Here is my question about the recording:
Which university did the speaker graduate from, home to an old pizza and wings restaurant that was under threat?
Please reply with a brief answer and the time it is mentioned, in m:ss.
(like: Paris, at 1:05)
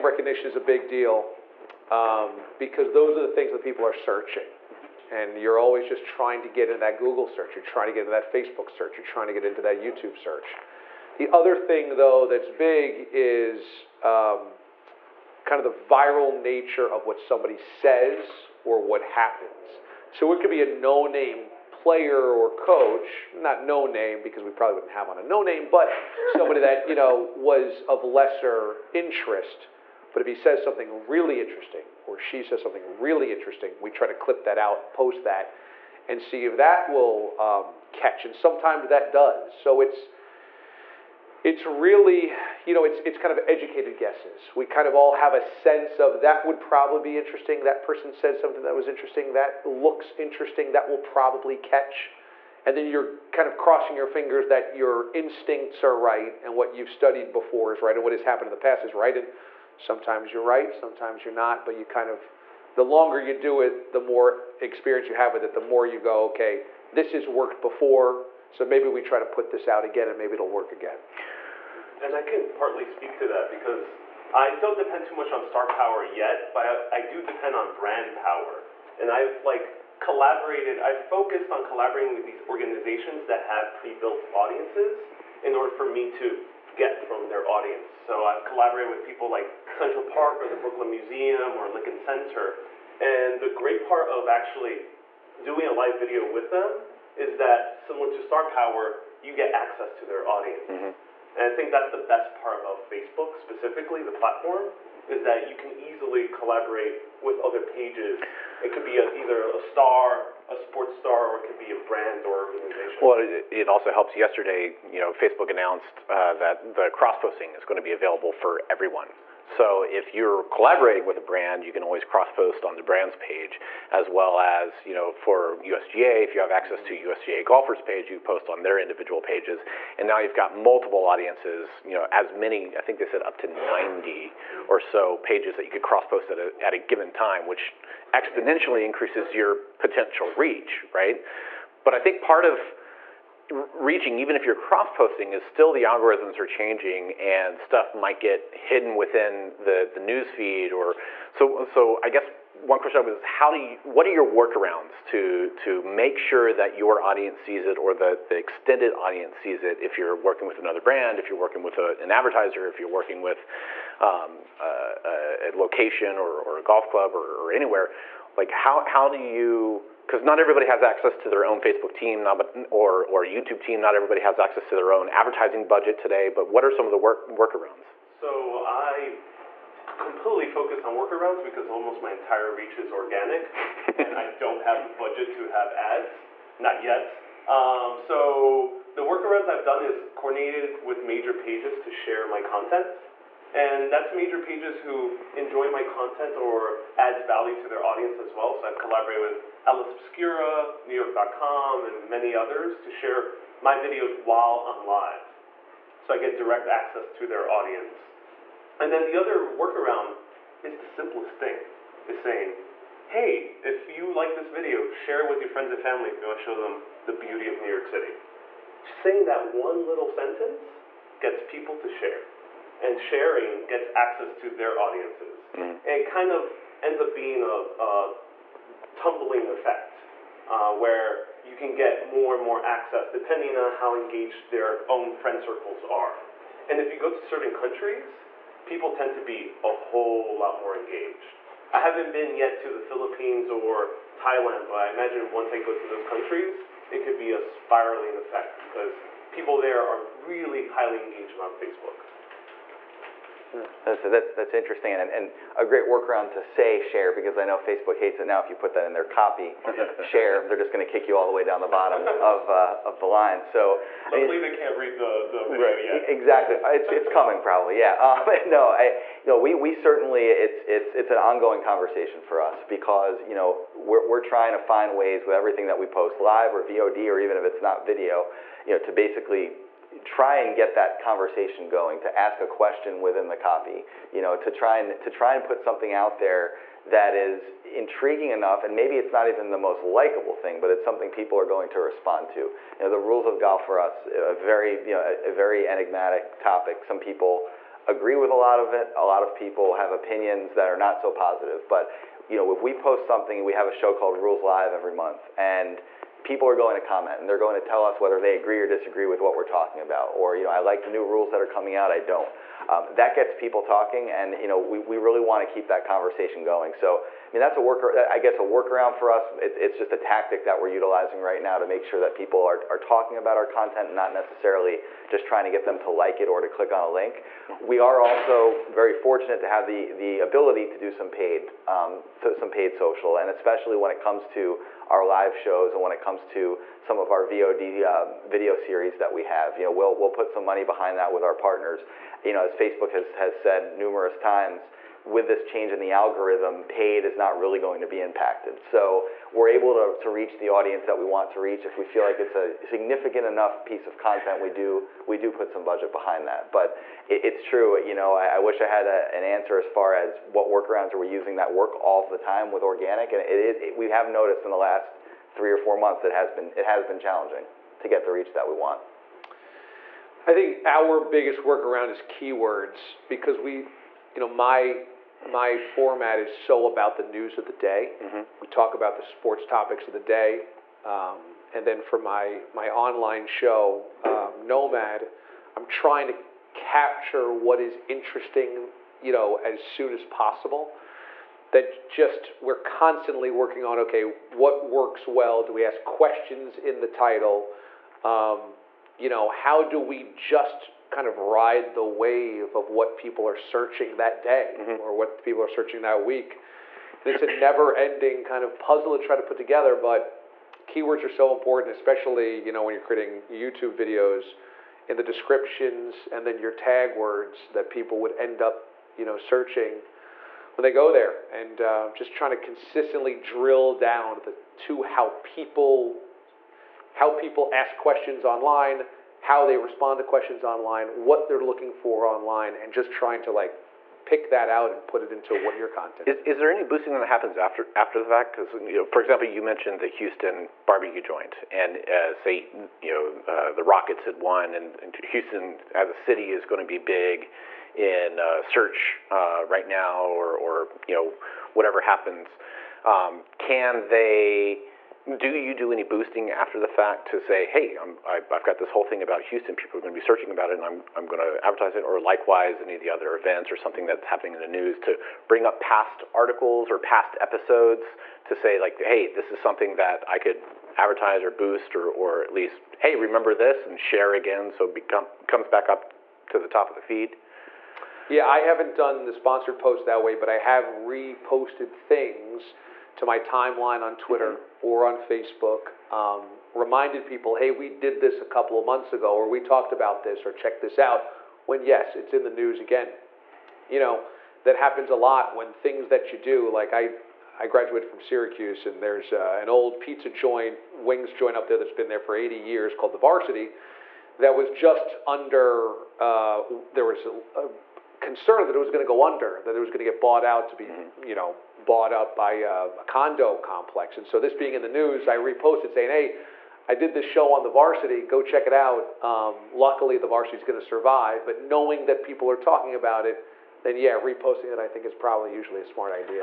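Syracuse, at 8:17.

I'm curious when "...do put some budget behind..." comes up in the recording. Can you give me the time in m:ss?
5:55.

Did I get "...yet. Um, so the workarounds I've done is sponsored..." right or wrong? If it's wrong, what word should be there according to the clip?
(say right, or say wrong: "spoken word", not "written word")
wrong: "coordinated", not "sponsored".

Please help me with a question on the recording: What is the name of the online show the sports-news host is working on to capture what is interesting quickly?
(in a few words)
Nomad.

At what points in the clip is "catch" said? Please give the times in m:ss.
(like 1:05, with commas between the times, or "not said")
0:37, 0:51.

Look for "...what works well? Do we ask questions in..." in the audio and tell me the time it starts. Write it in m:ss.
6:34.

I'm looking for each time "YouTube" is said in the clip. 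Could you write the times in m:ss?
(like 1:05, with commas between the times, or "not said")
0:09, 2:53, 6:53.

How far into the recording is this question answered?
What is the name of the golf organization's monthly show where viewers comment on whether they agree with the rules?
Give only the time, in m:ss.
5:04.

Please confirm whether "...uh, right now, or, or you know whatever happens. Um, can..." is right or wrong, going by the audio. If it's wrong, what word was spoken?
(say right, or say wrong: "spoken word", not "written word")
right.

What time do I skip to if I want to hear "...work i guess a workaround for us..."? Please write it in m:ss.
5:17.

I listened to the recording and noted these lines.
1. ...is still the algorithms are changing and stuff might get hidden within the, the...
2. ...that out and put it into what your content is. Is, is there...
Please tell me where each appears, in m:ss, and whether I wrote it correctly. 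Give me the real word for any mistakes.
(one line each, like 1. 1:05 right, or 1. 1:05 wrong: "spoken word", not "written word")
1. 2:25 right
2. 7:14 right.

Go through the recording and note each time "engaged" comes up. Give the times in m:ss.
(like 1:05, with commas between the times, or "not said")
3:53, 4:00, 4:10.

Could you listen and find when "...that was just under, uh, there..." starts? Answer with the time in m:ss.
8:24.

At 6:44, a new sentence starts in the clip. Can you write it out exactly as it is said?
or what people are searching that week.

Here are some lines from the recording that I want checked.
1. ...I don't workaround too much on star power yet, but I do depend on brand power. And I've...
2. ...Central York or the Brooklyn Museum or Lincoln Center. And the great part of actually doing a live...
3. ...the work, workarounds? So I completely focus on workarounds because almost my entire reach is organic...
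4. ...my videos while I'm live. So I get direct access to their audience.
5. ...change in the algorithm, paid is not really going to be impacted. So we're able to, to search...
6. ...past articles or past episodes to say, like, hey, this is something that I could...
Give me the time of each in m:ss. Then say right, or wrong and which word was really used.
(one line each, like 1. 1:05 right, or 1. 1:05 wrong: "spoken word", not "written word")
1. 1:14 wrong: "depend", not "workaround"
2. 1:29 wrong: "Park", not "York"
3. 2:56 right
4. 3:23 right
5. 5:45 wrong: "reach", not "search"
6. 7:45 right.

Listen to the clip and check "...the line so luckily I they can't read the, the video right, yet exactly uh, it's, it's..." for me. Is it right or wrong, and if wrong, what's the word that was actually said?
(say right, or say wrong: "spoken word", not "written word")
right.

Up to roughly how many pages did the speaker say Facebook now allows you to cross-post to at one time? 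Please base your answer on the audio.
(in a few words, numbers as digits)
90.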